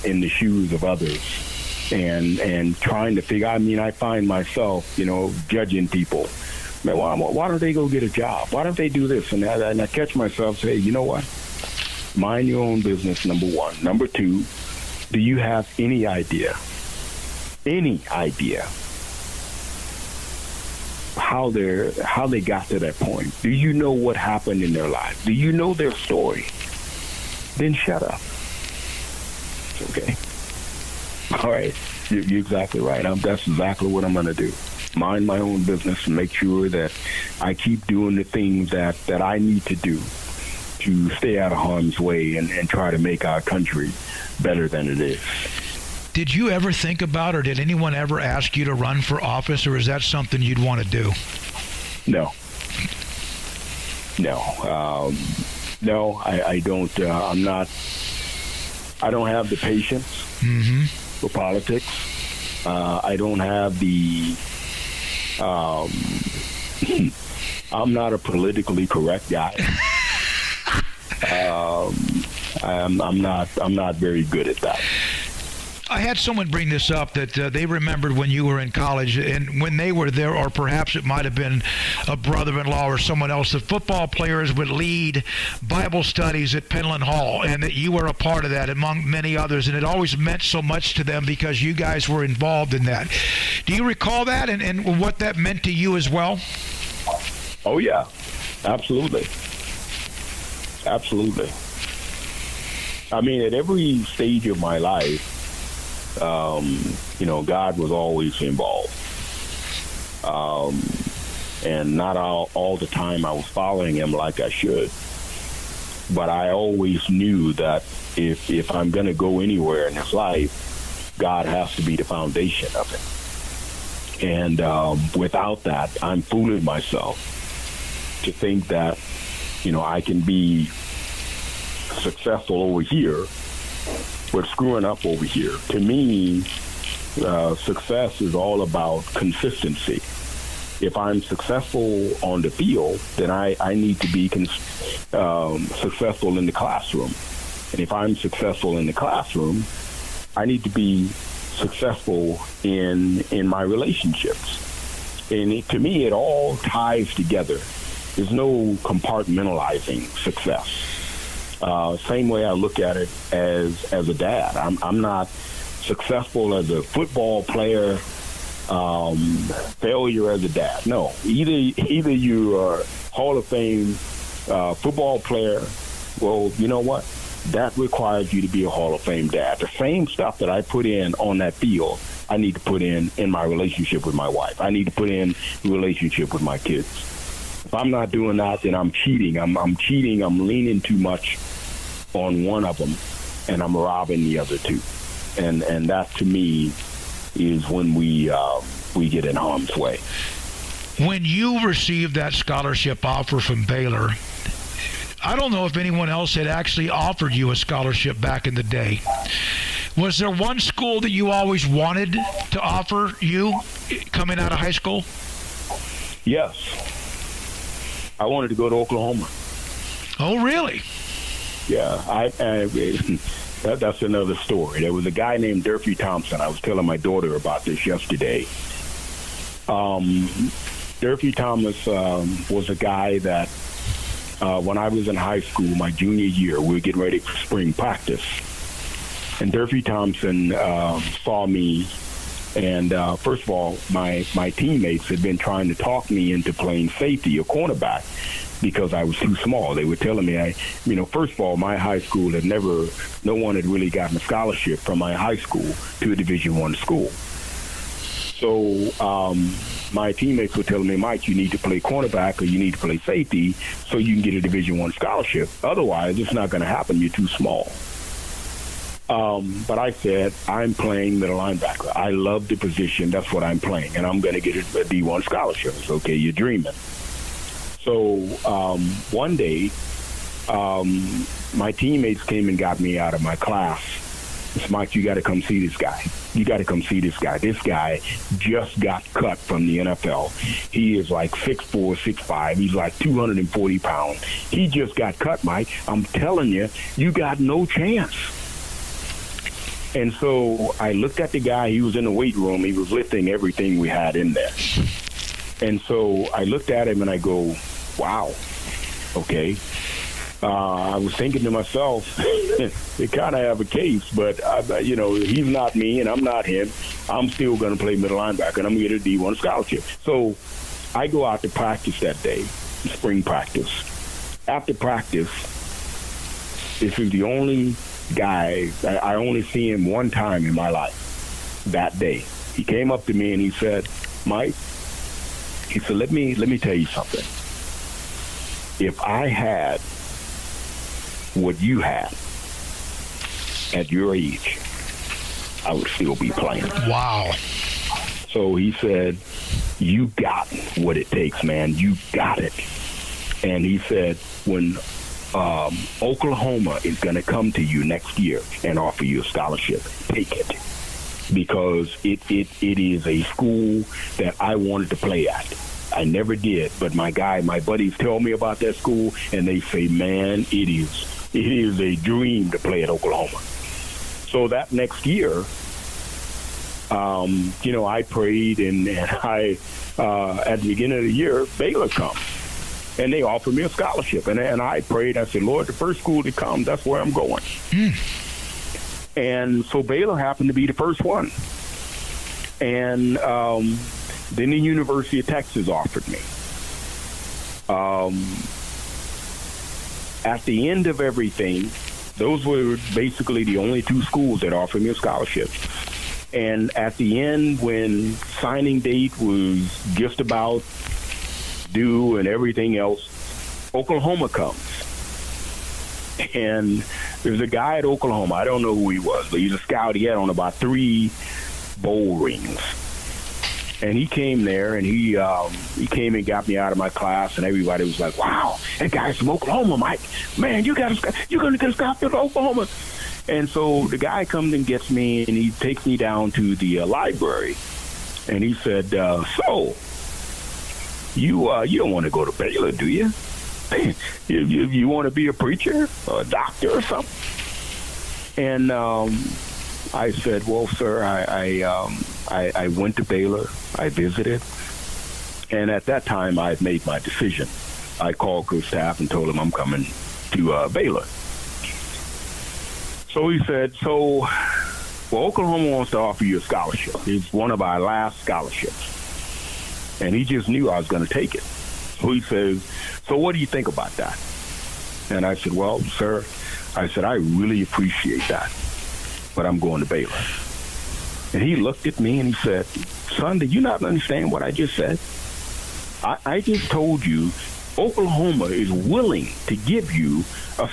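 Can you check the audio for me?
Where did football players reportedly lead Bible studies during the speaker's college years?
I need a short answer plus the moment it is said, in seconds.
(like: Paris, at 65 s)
Penland Hall, at 86 s.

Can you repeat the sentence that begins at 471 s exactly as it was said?
So he says, So what do you think about that?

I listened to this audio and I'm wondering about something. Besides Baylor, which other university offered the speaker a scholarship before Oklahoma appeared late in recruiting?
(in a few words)
University of Texas.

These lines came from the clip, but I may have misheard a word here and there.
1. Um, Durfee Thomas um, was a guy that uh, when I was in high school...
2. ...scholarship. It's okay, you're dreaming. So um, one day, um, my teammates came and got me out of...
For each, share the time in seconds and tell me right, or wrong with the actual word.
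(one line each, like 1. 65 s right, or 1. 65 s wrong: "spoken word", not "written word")
1. 229 s right
2. 275 s right.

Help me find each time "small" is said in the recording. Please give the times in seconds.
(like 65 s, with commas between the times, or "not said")
249 s, 267 s.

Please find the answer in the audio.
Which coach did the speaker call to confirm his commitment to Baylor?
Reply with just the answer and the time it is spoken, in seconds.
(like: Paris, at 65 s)
Coach Teaff, at 458 s.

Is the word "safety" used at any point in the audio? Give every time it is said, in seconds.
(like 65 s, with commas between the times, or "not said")
246 s, 262 s.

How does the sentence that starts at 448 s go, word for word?
And um, I said, well, sir, I I, um, I I went to Baylor.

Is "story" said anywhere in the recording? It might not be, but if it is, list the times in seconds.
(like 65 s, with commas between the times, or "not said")
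25 s, 224 s.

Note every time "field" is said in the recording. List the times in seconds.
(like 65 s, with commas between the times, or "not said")
142 s, 181 s.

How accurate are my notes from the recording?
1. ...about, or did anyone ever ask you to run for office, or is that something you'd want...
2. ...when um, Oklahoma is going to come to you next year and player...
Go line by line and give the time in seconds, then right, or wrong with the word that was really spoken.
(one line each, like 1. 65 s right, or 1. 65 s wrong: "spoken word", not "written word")
1. 47 s right
2. 354 s wrong: "offer", not "player".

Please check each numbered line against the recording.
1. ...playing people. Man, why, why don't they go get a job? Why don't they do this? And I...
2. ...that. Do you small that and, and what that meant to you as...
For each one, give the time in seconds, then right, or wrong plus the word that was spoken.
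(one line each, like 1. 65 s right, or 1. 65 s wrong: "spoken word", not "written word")
1. 5 s wrong: "judging", not "playing"
2. 92 s wrong: "recall", not "small".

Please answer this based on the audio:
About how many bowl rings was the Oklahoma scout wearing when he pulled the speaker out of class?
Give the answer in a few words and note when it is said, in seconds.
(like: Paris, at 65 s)
3, at 420 s.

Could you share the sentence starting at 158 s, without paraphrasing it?
There's no compartmentalizing success uh, same way I look at it as as a dad.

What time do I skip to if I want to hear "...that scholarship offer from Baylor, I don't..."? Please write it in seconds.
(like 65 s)
202 s.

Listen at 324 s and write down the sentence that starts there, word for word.
After practice, this is the only guy.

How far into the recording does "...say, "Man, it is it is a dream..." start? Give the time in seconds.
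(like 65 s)
369 s.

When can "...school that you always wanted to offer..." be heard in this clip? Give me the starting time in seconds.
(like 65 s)
210 s.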